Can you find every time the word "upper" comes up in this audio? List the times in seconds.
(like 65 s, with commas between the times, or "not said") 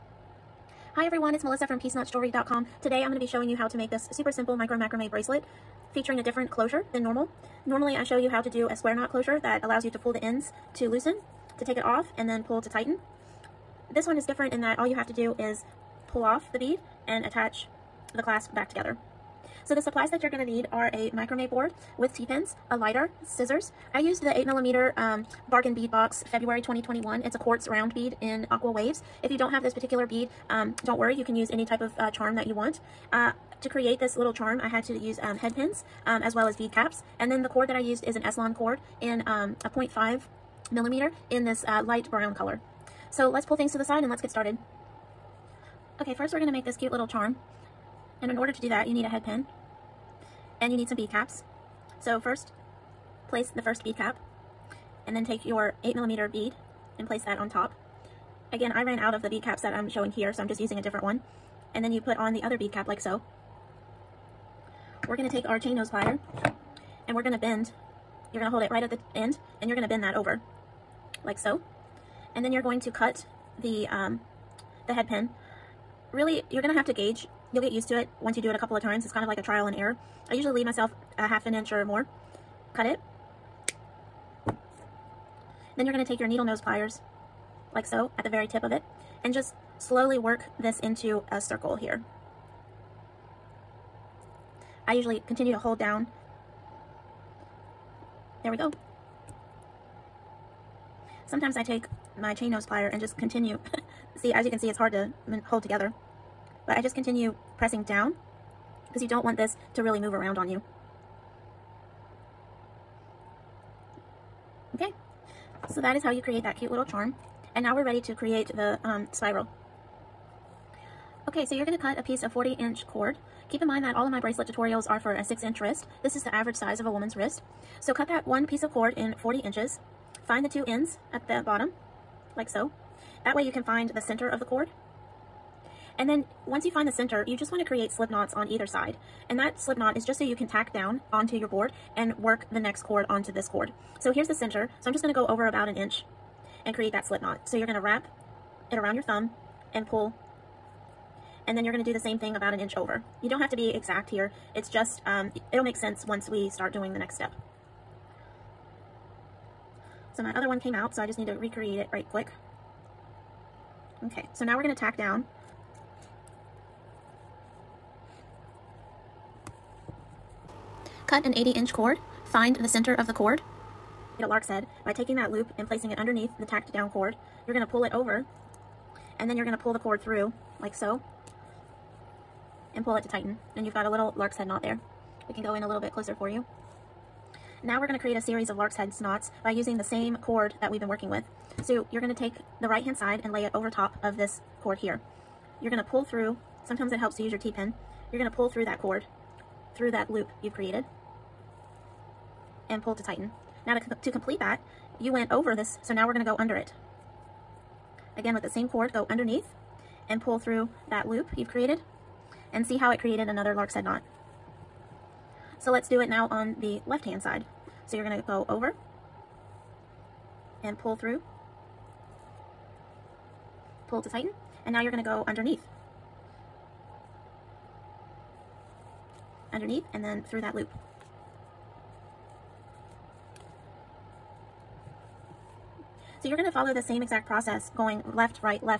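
not said.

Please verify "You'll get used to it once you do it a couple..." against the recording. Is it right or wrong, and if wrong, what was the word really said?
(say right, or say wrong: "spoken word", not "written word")
right.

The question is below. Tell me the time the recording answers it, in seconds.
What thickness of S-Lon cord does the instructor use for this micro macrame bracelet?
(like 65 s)
39 s.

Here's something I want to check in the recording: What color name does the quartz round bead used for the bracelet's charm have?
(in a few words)
aqua waves.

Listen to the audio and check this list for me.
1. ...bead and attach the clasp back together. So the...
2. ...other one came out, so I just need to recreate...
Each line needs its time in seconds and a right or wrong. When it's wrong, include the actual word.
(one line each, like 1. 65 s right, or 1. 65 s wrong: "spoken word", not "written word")
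1. 16 s right
2. 160 s right.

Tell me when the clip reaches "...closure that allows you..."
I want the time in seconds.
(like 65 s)
9 s.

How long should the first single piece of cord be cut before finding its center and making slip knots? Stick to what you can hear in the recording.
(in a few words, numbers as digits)
40 inches.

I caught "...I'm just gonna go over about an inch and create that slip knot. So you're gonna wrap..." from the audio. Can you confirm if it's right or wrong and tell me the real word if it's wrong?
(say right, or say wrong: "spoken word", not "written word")
right.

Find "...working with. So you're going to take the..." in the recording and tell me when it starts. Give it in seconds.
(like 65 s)
190 s.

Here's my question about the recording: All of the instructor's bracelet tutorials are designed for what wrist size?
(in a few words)
6 inch.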